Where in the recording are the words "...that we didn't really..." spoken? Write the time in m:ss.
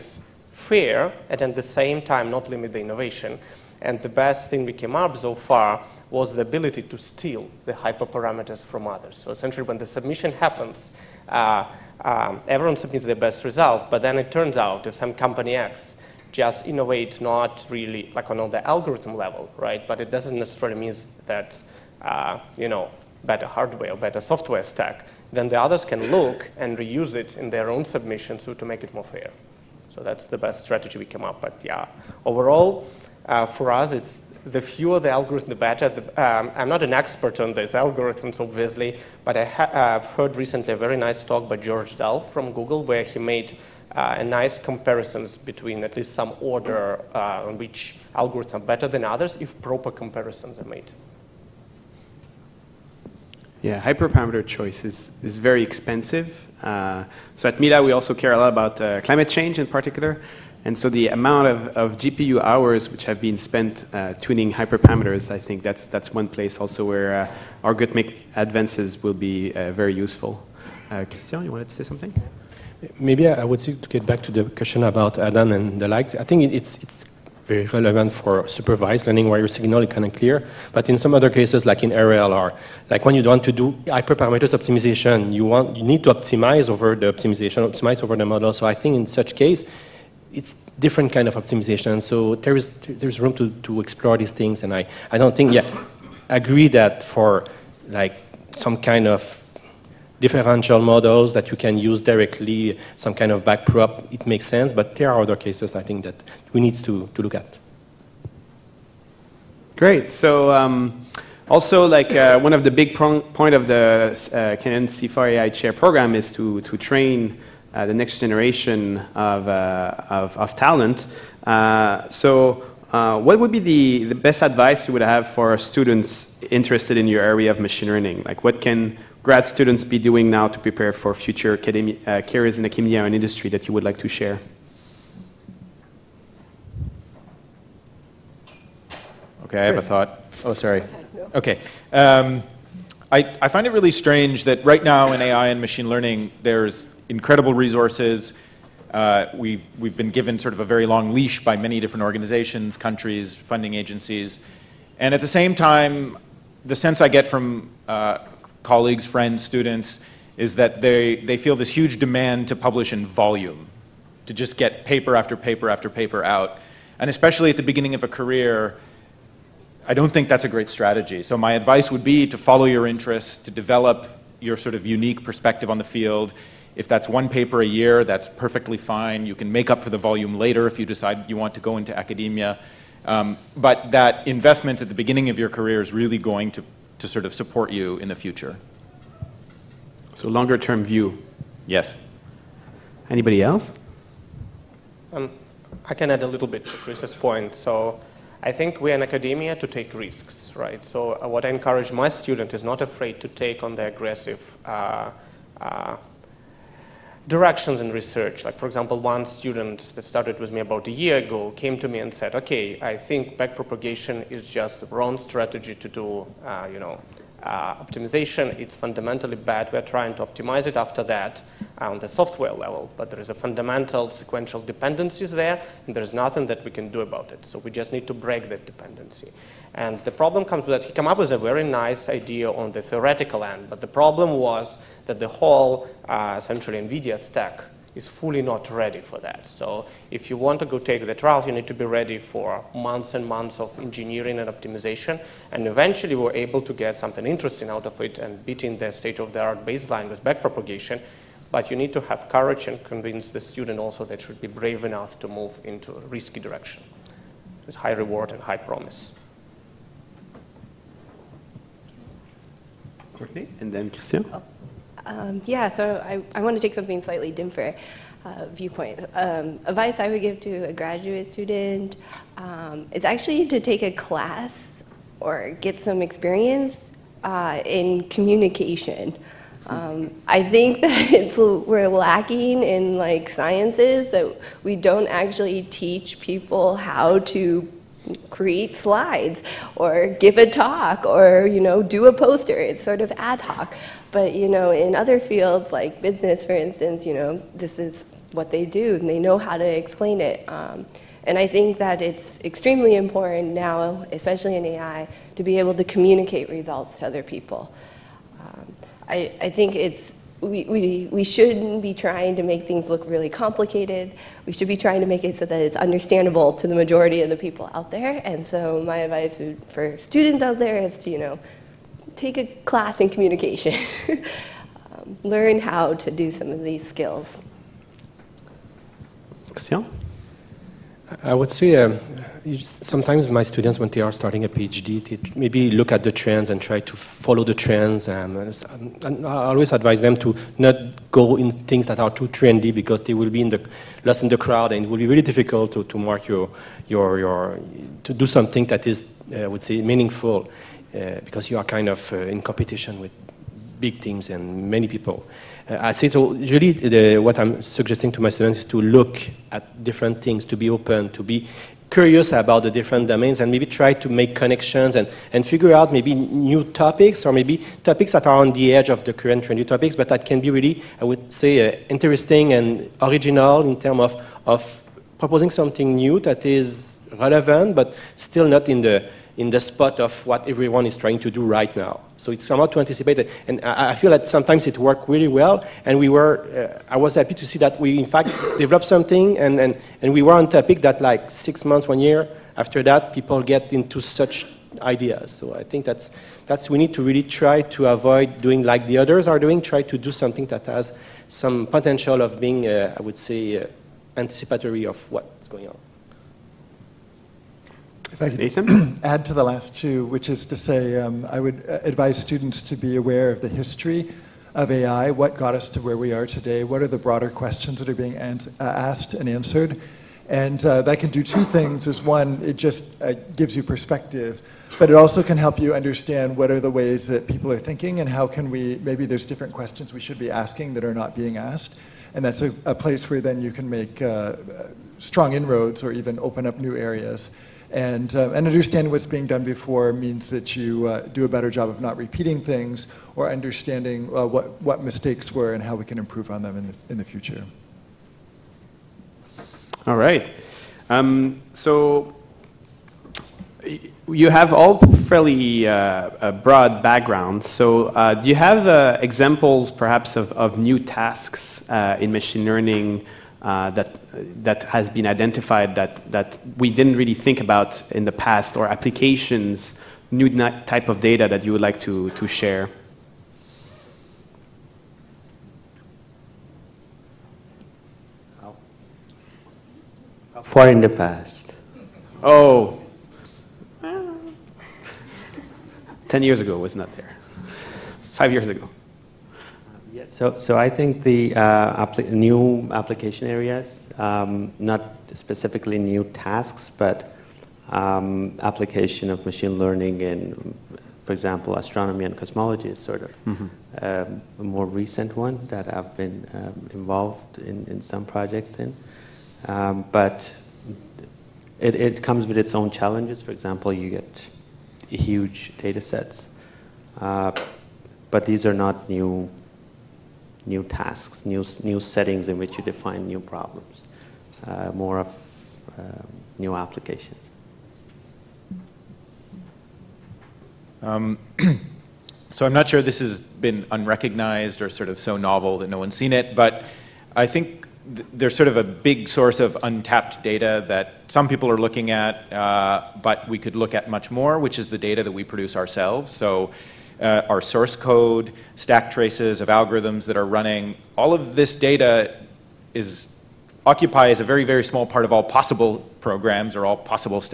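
7:46.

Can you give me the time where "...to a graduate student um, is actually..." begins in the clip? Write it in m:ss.
4:30.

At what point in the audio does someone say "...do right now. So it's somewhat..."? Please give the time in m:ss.
6:21.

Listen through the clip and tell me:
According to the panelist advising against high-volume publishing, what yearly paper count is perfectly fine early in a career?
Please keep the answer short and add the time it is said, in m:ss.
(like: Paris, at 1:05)
1 paper a year, at 2:57.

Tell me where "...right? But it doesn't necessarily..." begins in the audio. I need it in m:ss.
0:19.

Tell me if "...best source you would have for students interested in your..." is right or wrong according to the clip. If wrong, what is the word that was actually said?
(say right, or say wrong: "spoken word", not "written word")
wrong: "advice", not "source".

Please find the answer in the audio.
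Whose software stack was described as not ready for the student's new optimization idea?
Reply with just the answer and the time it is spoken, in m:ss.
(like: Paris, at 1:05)
NVIDIA, at 3:56.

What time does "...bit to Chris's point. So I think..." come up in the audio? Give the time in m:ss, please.
3:16.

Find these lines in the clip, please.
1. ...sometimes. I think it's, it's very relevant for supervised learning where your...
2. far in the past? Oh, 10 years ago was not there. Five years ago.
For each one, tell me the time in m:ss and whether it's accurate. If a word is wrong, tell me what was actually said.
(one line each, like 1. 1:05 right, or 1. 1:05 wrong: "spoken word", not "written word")
1. 1:15 wrong: "likes", not "sometimes"
2. 8:00 right.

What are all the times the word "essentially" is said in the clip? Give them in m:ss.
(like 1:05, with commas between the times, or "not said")
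0:09, 3:56.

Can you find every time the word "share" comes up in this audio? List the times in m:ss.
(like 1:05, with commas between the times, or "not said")
2:14, 7:52.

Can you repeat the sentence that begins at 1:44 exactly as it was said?
But there are other cases I think that we need to to look at.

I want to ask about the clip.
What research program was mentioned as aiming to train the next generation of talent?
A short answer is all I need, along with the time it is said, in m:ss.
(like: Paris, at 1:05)
Canada CIFAR AI chair program, at 1:54.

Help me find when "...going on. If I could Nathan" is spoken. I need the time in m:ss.
6:45.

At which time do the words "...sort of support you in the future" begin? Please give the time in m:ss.
3:07.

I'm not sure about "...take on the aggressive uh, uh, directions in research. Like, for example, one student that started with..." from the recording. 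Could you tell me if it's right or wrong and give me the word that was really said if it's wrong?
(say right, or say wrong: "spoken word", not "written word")
right.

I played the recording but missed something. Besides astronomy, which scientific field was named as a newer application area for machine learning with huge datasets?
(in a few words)
cosmology.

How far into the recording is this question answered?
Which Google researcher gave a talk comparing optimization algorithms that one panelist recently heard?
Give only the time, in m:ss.
0:41.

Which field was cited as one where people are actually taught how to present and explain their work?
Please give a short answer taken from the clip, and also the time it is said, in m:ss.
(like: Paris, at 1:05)
business, at 4:56.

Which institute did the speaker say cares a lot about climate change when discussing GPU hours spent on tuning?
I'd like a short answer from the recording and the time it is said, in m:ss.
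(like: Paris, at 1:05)
Mila, at 0:57.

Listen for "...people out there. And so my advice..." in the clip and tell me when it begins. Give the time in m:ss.
5:17.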